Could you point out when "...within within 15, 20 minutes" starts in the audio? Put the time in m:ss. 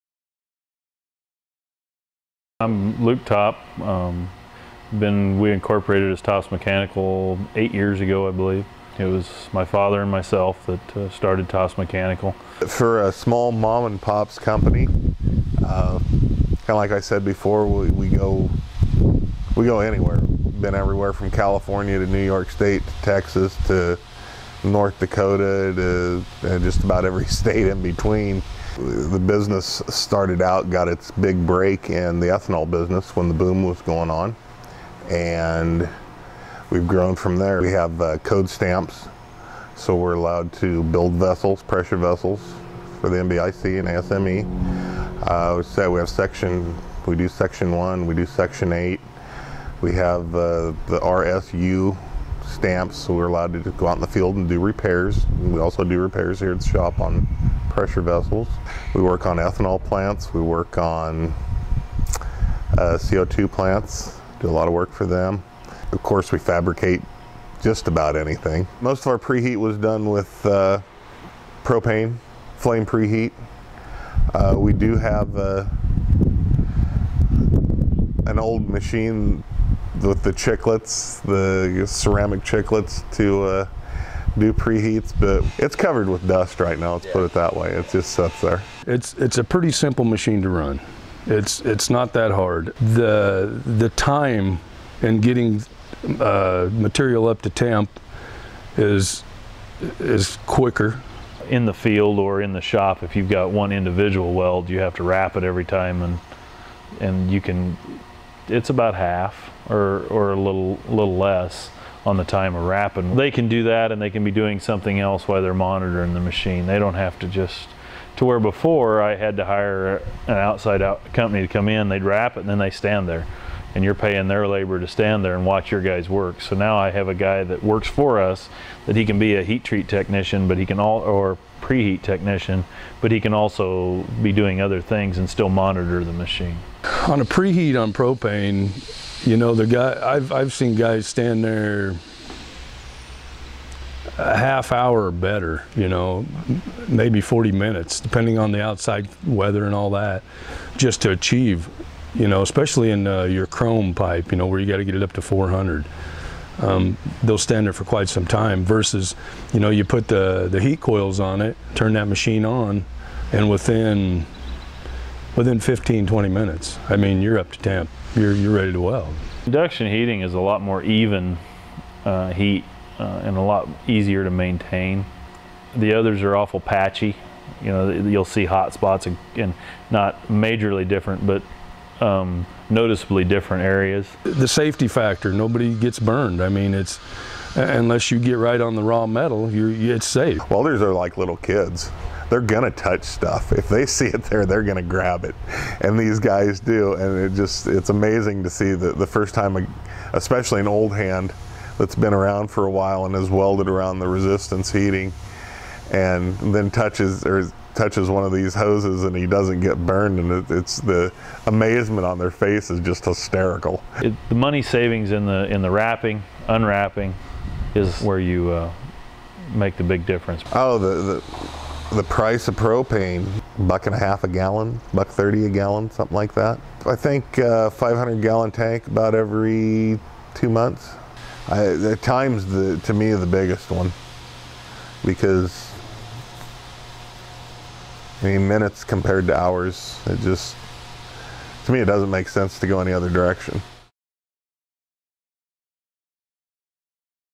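2:43.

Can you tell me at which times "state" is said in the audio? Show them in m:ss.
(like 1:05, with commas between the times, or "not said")
0:22, 0:27.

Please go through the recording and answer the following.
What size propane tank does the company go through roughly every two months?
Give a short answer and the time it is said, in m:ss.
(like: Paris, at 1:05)
500 gallon, at 3:47.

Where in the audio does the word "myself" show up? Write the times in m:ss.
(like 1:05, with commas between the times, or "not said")
0:10.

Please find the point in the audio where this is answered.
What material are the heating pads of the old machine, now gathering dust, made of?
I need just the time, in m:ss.
1:21.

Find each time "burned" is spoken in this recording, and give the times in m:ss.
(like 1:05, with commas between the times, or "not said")
3:05, 3:29.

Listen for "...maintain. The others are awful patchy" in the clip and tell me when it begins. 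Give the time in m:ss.
2:54.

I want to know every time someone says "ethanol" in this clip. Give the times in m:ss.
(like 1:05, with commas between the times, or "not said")
0:32, 0:59.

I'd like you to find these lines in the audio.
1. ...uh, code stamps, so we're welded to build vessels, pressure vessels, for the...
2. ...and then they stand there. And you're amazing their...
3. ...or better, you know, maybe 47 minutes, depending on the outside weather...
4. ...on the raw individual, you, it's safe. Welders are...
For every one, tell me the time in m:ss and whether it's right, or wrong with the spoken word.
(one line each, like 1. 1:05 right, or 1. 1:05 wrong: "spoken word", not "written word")
1. 0:38 wrong: "allowed", not "welded"
2. 2:02 wrong: "paying", not "amazing"
3. 2:25 wrong: "40", not "47"
4. 3:08 wrong: "metal", not "individual".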